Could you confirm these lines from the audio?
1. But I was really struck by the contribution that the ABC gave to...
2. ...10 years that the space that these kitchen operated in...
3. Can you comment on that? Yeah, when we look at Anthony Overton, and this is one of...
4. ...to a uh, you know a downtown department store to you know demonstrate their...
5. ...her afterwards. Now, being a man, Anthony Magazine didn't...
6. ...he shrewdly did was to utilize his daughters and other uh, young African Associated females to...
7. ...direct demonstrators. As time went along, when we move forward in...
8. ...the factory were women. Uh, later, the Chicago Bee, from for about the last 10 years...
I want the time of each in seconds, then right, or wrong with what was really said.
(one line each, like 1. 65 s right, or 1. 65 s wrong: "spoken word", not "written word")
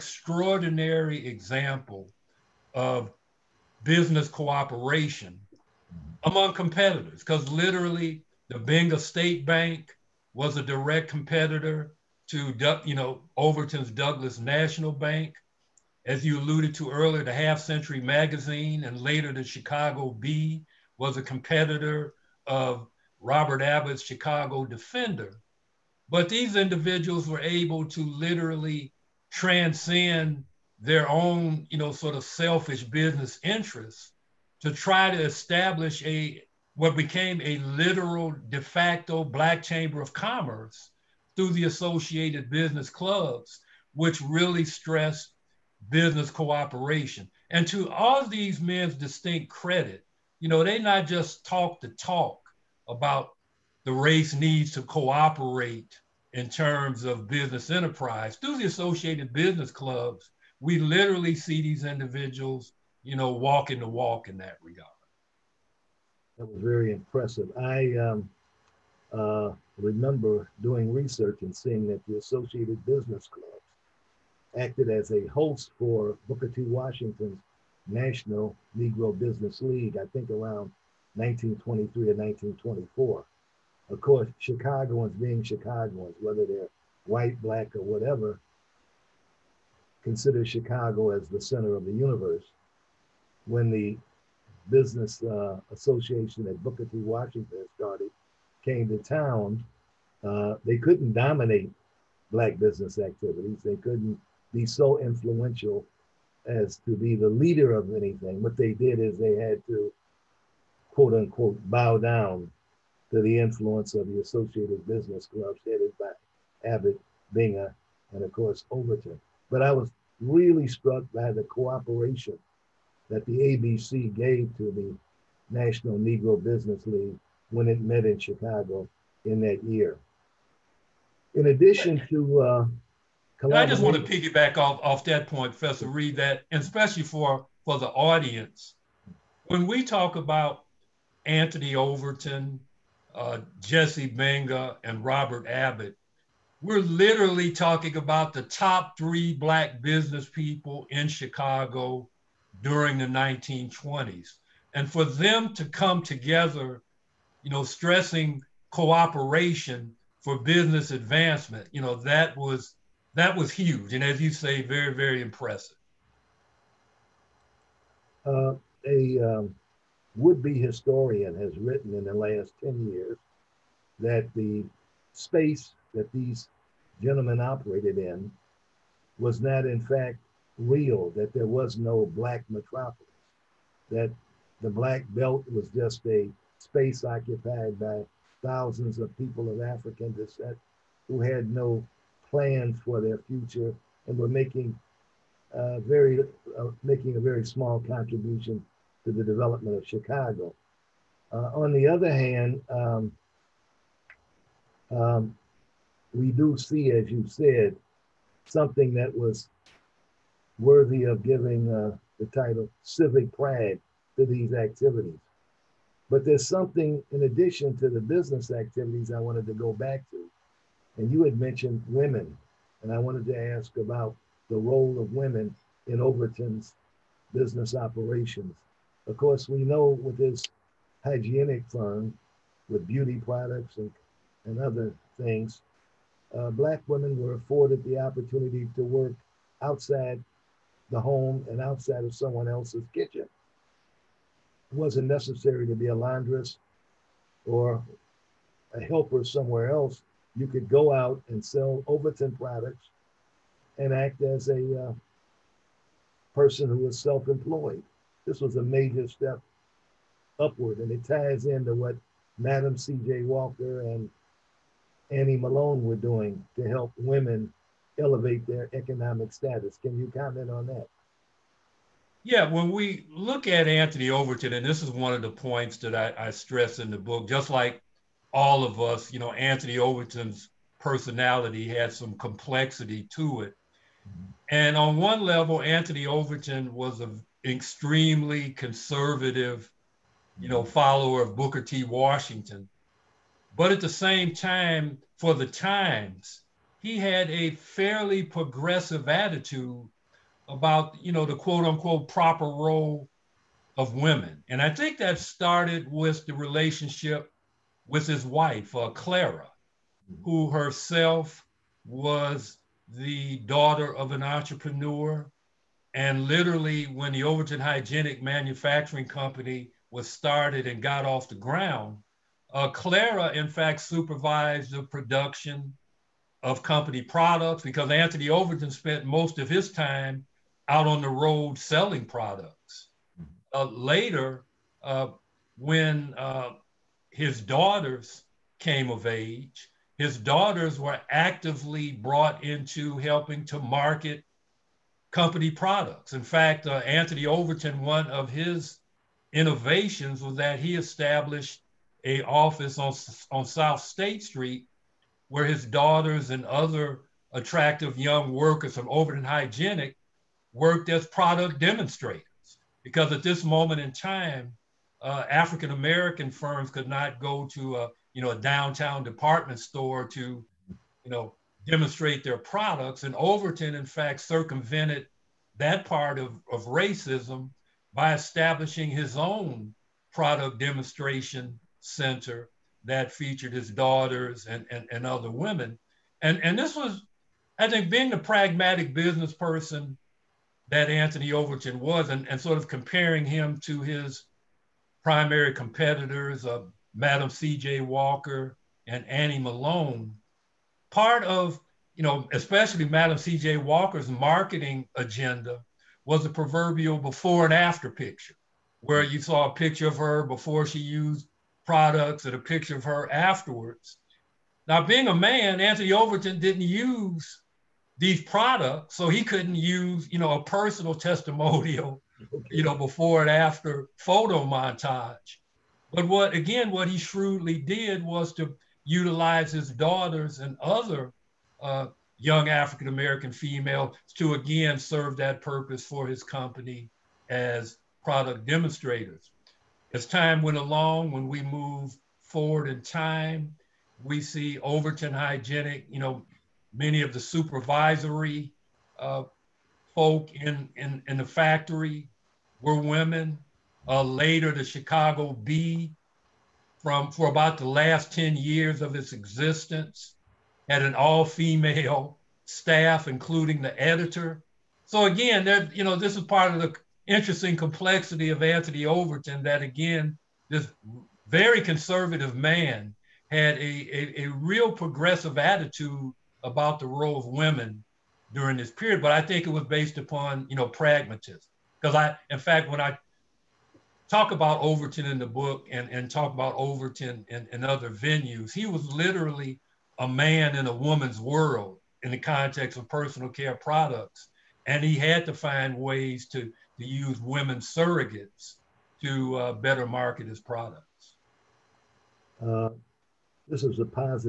1. 119 s wrong: "cooperation", not "contribution"
2. 172 s wrong: "gentlemen", not "kitchen"
3. 269 s right
4. 367 s right
5. 412 s wrong: "Overton", not "Magazine"
6. 426 s wrong: "American", not "Associated"
7. 438 s wrong: "product", not "direct"
8. 451 s right.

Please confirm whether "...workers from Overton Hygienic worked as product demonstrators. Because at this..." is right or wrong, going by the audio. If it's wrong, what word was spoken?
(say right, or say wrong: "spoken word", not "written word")
right.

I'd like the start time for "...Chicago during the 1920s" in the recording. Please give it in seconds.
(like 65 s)
151 s.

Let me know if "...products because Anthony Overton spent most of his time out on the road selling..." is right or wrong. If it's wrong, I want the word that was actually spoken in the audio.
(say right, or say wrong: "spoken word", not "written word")
right.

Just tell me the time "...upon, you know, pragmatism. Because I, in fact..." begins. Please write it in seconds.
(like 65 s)
479 s.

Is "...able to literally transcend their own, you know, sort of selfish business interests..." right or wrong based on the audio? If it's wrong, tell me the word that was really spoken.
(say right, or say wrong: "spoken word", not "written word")
right.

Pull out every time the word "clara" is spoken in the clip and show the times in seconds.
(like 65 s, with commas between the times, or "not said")
308 s, 322 s.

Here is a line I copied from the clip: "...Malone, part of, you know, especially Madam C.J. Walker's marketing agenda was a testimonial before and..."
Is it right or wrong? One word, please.
wrong.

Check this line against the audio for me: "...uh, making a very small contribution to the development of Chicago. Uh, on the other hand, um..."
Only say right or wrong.
right.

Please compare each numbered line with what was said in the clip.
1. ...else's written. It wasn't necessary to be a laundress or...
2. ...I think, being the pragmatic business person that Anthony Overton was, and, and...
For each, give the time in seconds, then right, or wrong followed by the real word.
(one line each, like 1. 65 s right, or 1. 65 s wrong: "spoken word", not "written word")
1. 242 s wrong: "kitchen", not "written"
2. 387 s right.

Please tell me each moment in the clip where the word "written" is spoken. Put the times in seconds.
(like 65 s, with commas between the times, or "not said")
171 s.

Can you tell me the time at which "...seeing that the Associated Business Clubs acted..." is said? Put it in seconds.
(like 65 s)
71 s.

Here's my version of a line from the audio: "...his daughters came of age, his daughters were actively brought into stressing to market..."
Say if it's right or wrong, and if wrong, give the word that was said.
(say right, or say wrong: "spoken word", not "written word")
wrong: "helping", not "stressing".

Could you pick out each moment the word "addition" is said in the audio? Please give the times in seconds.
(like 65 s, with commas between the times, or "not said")
131 s, 217 s.